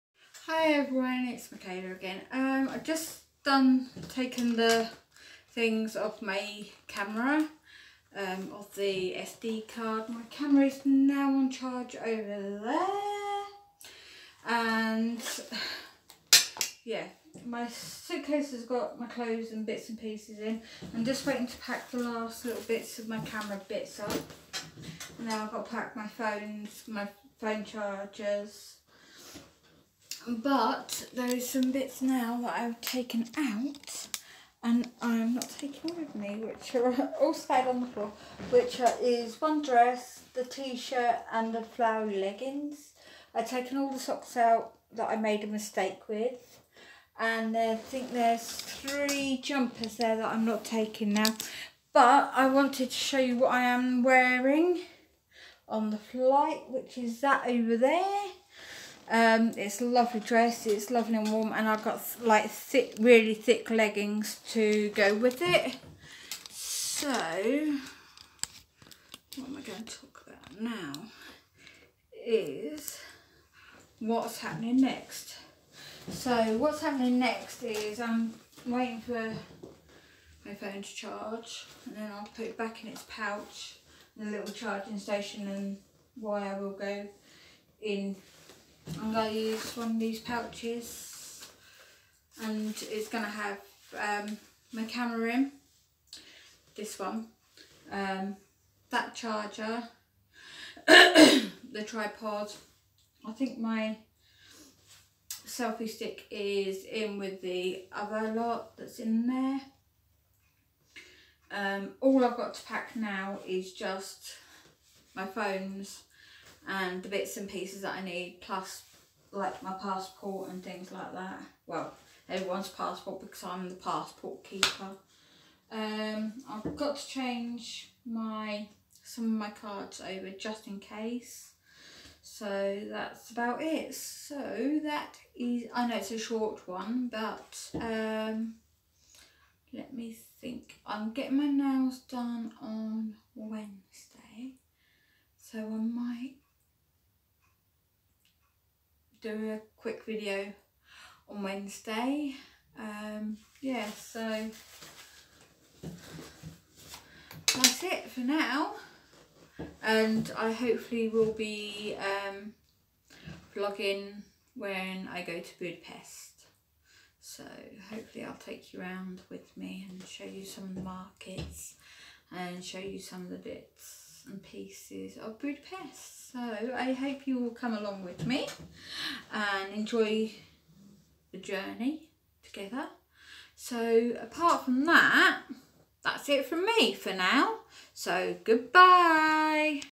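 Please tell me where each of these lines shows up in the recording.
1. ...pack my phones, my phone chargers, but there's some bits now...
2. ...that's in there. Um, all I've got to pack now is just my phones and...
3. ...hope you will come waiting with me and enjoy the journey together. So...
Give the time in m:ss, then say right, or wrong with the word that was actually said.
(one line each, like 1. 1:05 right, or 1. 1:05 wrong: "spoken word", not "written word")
1. 0:25 right
2. 1:48 right
3. 2:56 wrong: "along", not "waiting".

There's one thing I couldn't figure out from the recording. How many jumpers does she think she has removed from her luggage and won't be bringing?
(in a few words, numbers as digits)
3.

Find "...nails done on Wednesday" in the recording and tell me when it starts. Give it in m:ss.
2:21.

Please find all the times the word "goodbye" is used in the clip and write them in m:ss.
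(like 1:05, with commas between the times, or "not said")
3:08.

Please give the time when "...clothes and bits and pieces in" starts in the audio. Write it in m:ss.
0:19.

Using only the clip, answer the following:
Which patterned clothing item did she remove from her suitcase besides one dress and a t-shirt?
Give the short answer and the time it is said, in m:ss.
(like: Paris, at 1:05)
flowery leggings, at 0:41.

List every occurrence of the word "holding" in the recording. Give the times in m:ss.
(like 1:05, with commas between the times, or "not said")
not said.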